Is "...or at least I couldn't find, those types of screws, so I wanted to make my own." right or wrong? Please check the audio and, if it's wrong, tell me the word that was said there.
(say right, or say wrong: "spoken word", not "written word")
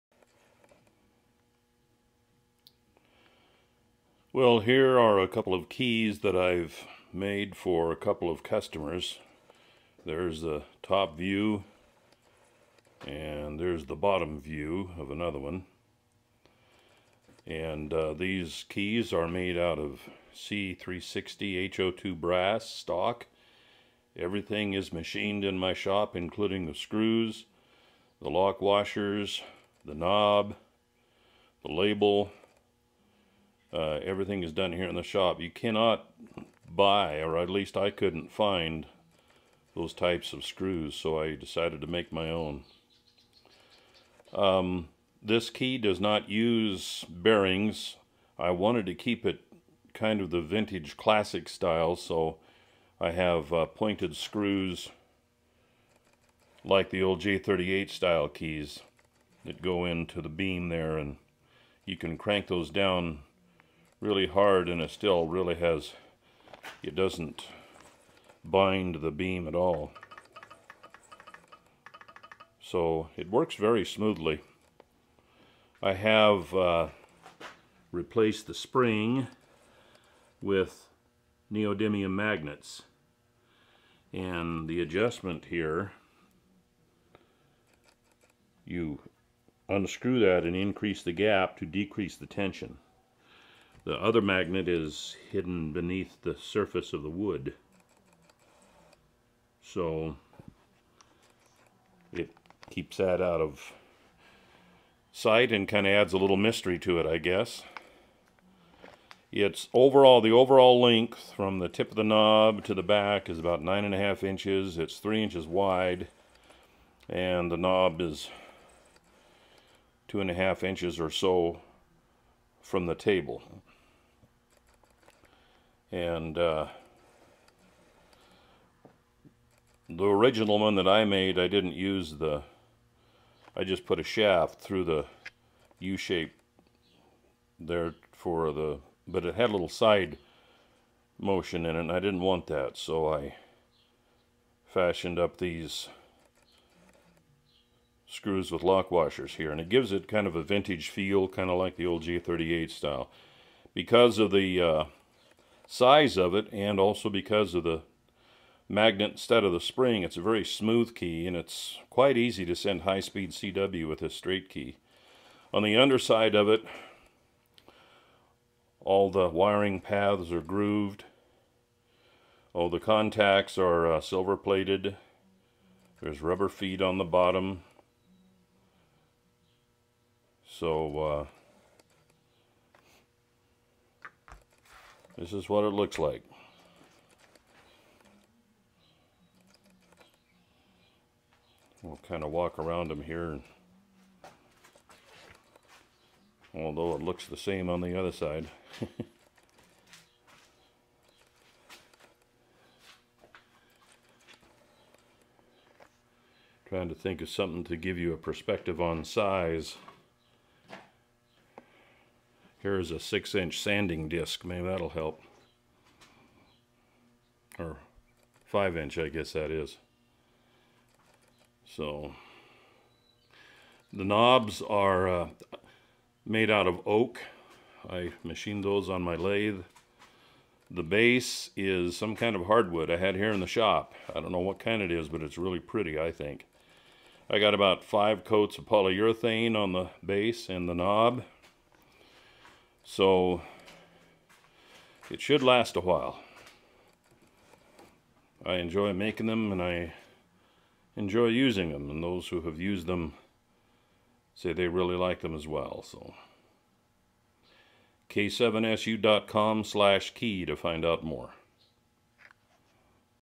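wrong: "decided", not "wanted".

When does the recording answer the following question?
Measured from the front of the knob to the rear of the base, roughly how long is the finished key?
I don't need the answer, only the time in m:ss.
1:53.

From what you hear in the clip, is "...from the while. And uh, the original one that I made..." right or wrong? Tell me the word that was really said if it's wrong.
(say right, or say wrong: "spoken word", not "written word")
wrong: "table", not "while".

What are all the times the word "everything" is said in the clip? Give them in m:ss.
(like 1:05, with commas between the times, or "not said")
0:24, 0:34.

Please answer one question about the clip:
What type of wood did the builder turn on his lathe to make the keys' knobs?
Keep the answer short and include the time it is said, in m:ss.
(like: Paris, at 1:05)
oak, at 3:46.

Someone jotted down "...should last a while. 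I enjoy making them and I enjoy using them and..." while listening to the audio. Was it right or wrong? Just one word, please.
right.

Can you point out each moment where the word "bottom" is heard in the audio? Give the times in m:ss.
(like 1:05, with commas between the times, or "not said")
0:13, 2:57.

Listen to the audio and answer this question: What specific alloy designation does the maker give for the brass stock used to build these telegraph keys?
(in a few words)
C360 HO2.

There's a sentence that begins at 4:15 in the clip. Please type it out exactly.
So k7su.com slash key to find out more.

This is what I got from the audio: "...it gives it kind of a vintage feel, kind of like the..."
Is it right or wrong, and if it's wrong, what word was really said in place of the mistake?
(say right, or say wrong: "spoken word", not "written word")
right.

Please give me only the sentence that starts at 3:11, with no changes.
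We'll kind of walk around them here.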